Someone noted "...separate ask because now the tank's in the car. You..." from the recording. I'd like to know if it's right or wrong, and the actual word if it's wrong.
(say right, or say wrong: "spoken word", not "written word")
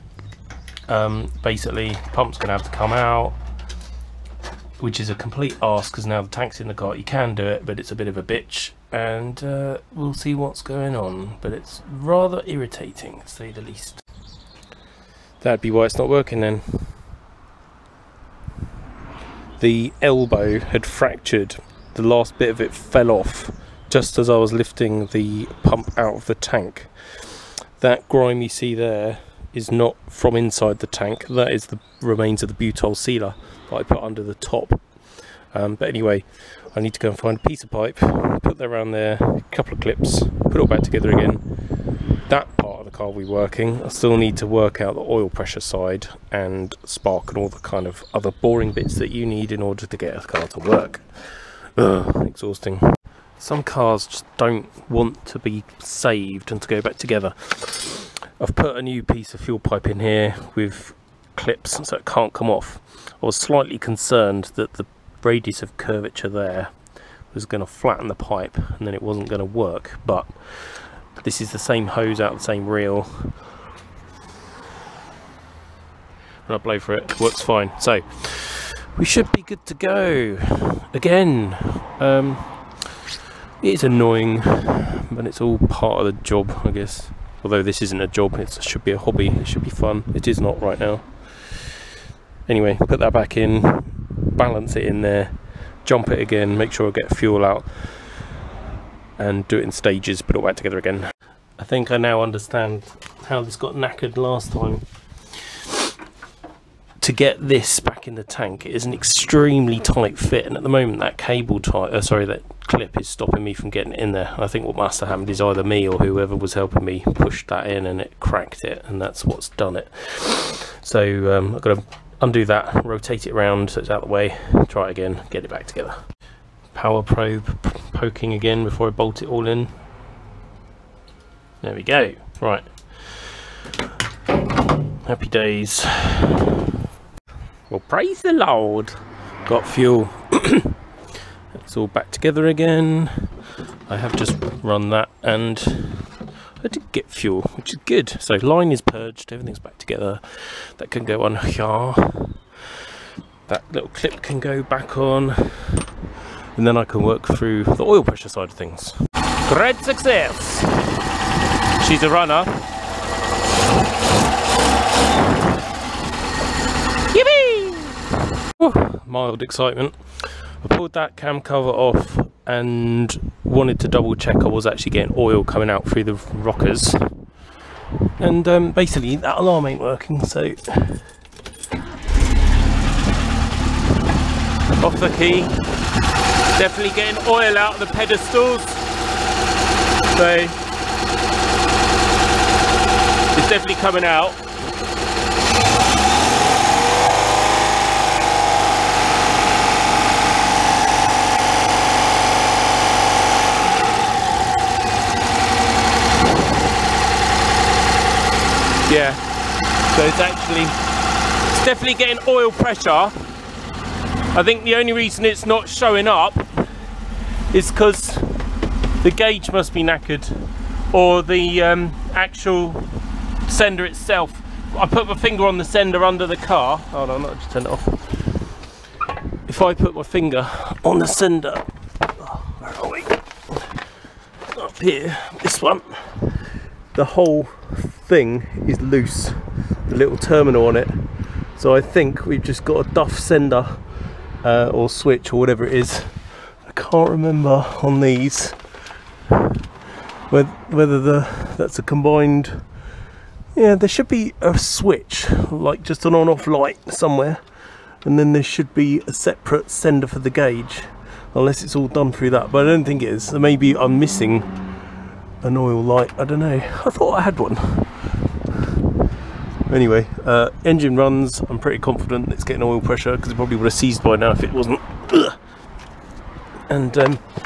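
wrong: "complete", not "separate".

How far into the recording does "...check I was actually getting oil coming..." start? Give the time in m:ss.
2:54.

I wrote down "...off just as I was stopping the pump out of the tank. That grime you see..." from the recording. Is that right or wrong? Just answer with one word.
wrong.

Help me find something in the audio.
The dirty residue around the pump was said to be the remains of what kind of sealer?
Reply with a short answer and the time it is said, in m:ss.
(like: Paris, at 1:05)
Butyl sealer, at 0:32.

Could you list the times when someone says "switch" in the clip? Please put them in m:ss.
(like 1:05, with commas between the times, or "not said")
4:04, 4:14.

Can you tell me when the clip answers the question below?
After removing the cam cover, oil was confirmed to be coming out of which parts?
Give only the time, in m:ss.
3:07.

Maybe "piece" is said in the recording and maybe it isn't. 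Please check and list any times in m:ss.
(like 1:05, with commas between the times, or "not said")
0:37, 0:59.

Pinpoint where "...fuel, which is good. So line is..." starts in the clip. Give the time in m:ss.
2:27.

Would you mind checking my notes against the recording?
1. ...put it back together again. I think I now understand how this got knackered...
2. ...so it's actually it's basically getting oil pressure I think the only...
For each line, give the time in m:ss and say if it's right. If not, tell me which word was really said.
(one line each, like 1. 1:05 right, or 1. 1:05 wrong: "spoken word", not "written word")
1. 1:40 right
2. 3:29 wrong: "definitely", not "basically".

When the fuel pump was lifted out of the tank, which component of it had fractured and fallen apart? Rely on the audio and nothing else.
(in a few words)
The elbow.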